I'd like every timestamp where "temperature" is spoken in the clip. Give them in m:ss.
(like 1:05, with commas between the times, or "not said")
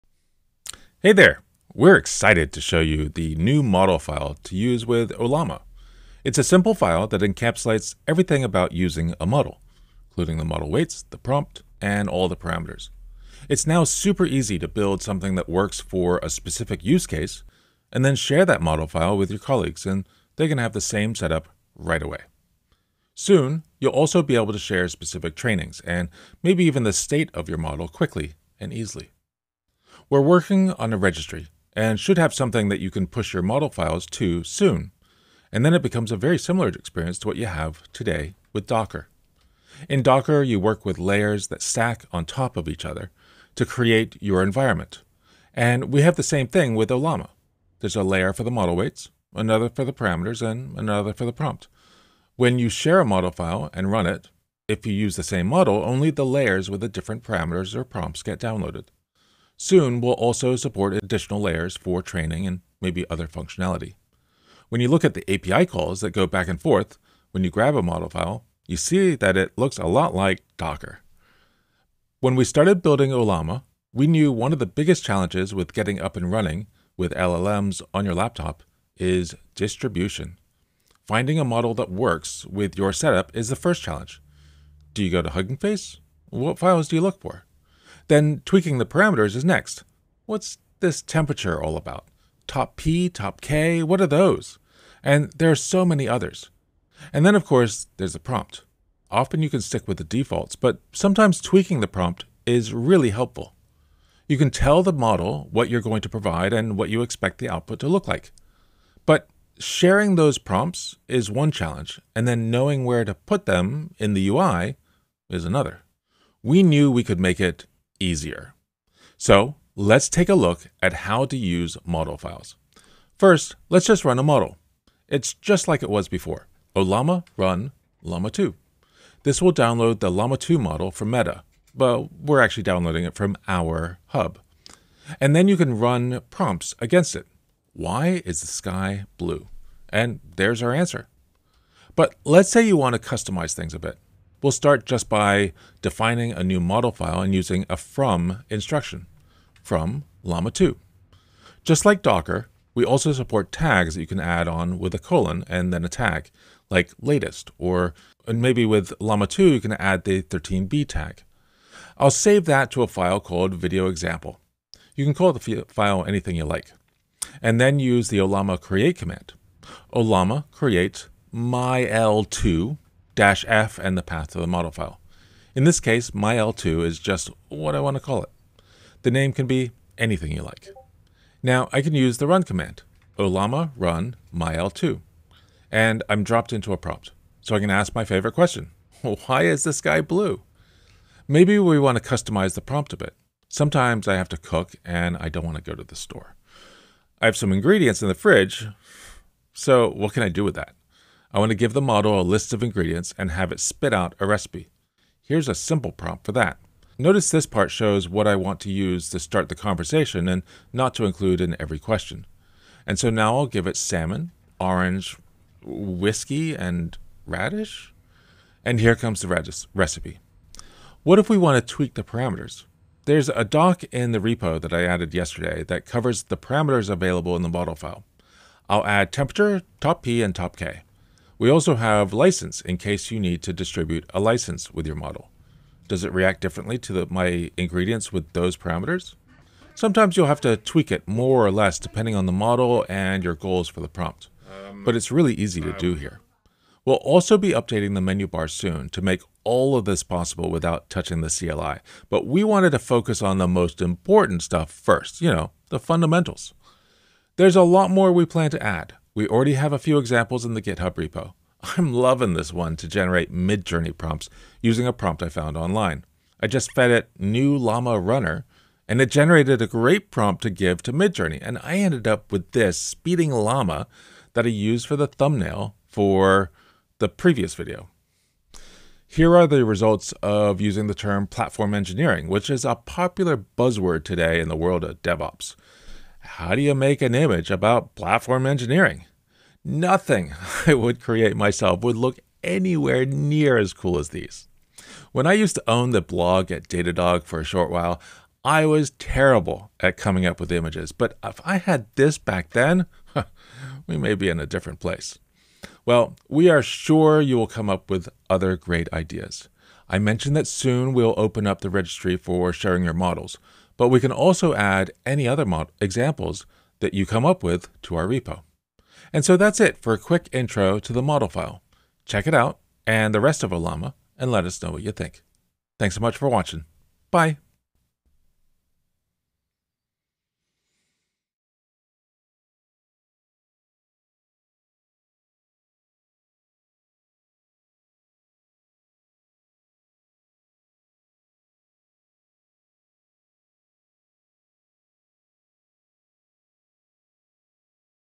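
1:31, 3:49.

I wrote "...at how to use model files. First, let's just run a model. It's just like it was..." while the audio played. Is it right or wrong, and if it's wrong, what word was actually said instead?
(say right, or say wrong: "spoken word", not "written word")
right.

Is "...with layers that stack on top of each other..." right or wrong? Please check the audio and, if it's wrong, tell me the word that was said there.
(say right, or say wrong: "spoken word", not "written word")
right.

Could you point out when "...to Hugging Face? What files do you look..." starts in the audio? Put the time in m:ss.
1:25.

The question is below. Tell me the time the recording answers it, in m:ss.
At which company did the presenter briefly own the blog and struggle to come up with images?
4:56.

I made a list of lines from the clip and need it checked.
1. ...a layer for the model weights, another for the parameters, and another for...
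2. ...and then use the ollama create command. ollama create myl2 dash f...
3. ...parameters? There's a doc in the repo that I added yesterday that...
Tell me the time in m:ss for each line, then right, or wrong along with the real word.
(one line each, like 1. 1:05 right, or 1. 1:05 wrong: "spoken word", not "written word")
1. 0:47 right
2. 2:47 right
3. 3:42 right.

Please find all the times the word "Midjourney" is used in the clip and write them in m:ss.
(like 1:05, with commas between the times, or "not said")
4:23, 4:30.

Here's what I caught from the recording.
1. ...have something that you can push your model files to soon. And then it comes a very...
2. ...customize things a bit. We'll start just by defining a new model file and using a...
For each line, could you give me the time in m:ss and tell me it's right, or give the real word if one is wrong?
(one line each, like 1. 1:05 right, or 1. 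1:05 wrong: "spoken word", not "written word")
1. 0:32 wrong: "becomes", not "comes"
2. 2:23 right.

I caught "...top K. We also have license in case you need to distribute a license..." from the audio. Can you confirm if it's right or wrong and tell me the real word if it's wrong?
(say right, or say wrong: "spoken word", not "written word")
right.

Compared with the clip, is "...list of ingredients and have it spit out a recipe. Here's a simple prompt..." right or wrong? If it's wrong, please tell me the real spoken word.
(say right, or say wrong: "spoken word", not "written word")
right.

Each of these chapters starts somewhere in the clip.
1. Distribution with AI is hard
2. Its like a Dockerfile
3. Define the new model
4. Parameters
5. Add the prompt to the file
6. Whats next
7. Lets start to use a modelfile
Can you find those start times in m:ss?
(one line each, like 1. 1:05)
1. 1:11
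2. 0:37
3. 2:25
4. 3:39
5. 3:11
6. 4:07
7. 1:59.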